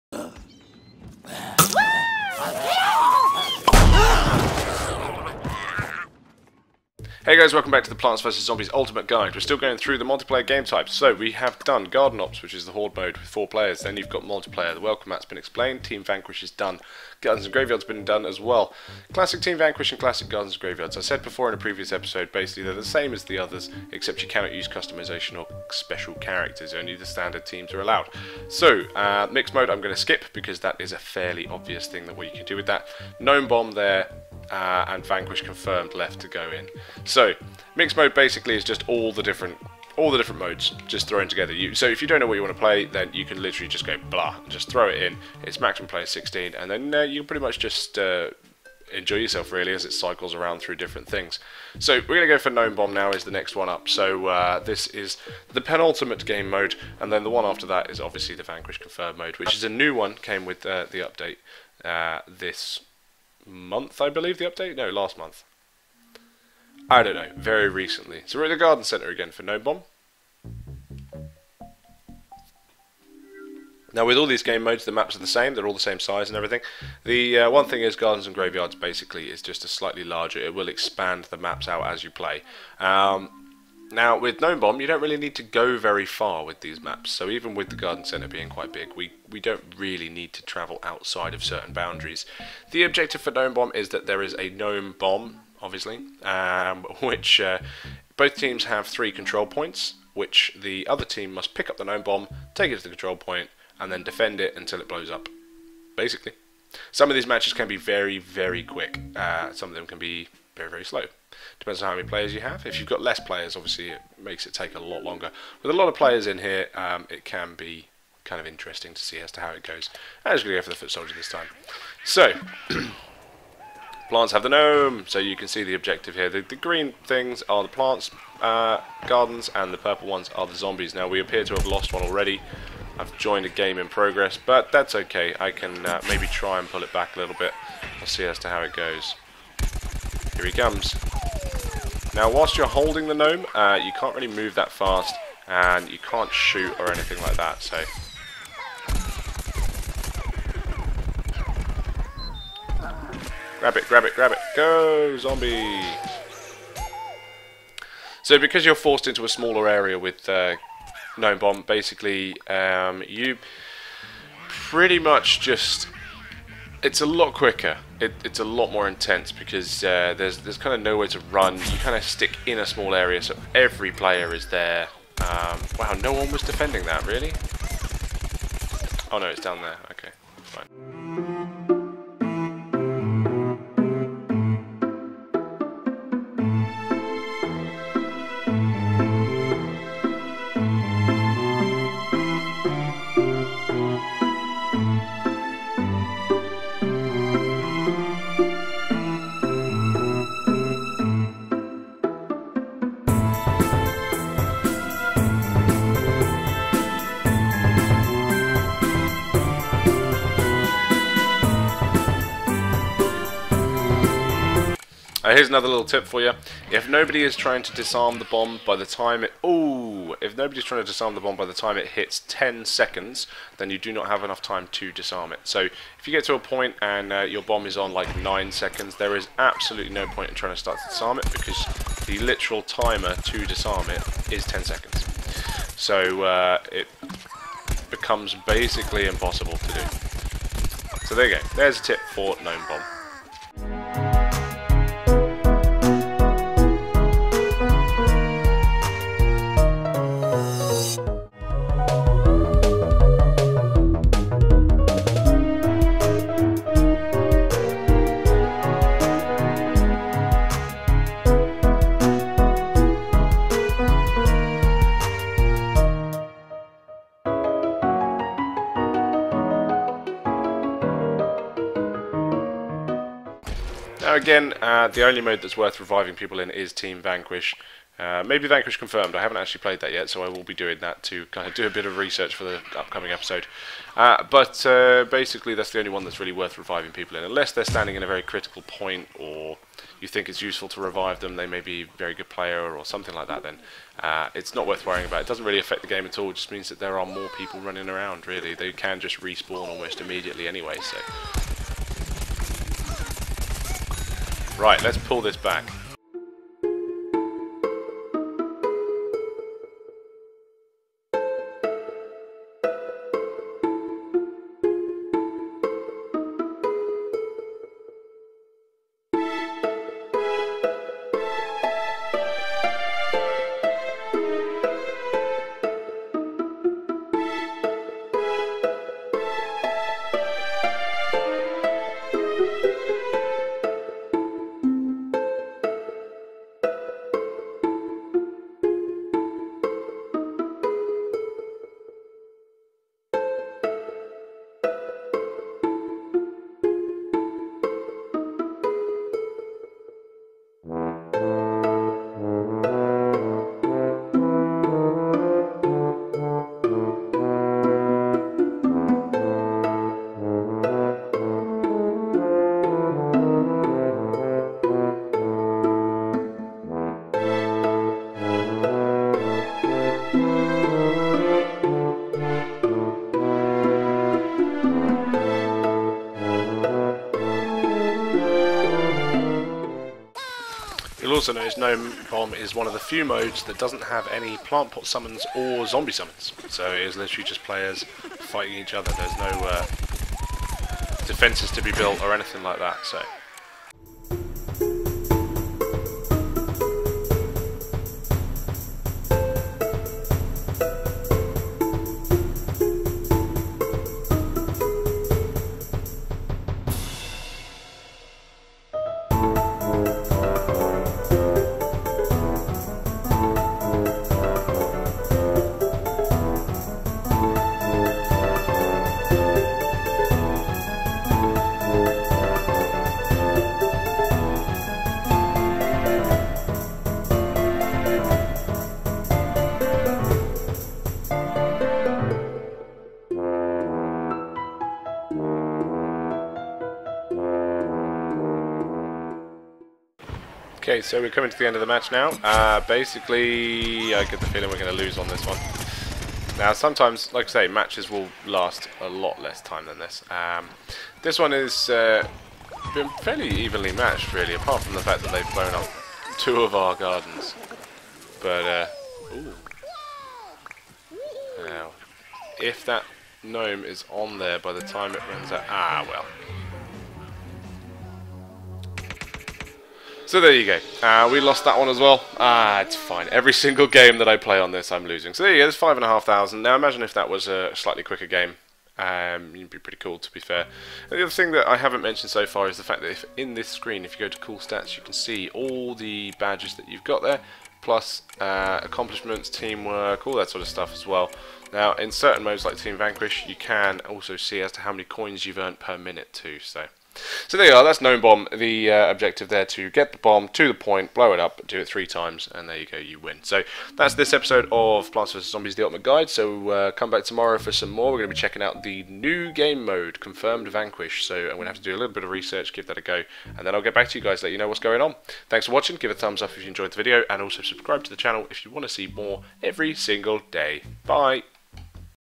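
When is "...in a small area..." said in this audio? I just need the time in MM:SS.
02:52.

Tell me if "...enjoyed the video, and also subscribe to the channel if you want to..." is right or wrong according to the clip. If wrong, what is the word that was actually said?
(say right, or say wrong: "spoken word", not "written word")
right.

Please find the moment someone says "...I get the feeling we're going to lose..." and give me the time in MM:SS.
07:23.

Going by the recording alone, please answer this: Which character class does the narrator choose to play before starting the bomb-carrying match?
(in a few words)
Foot soldier.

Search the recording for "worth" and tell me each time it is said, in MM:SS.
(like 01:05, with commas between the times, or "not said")
04:35, 04:46, 04:54.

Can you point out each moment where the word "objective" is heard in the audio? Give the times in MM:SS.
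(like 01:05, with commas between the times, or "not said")
01:32, 02:05, 08:18.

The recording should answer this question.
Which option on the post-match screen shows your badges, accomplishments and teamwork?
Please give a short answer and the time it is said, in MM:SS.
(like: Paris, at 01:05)
Cool Stats, at 08:04.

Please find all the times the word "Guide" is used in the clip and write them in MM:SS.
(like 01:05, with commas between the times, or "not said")
00:09, 08:25.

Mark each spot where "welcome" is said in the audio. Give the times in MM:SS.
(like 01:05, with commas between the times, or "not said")
00:07, 00:14.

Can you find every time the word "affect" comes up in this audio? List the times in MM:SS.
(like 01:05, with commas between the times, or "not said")
04:55.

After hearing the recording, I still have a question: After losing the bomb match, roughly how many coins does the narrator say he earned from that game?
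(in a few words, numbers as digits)
5,500.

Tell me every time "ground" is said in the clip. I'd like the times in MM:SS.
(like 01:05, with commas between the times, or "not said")
not said.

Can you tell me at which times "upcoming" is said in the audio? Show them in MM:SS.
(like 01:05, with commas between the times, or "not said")
04:42.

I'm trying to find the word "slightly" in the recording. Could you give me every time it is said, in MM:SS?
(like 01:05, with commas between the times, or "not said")
01:19, 07:57.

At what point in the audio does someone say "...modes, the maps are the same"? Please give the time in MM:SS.
01:14.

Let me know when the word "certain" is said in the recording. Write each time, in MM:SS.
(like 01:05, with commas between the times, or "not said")
01:31, 08:11.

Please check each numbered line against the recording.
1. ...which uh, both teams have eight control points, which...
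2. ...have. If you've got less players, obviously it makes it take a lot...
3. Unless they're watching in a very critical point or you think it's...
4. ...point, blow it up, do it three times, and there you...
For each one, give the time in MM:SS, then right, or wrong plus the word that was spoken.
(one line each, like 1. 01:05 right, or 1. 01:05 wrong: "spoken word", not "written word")
1. 01:37 wrong: "three", not "eight"
2. 01:52 right
3. 04:47 wrong: "standing", not "watching"
4. 08:20 right.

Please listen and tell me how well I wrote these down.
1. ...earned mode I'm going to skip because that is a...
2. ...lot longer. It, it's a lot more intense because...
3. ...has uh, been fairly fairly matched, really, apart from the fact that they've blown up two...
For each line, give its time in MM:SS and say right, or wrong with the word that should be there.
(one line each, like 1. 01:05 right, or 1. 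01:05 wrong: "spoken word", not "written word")
1. 00:29 wrong: "mixed", not "earned"
2. 02:47 wrong: "quicker", not "longer"
3. 07:31 wrong: "evenly", not "fairly".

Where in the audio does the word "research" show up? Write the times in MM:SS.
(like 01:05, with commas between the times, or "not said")
04:41, 08:32.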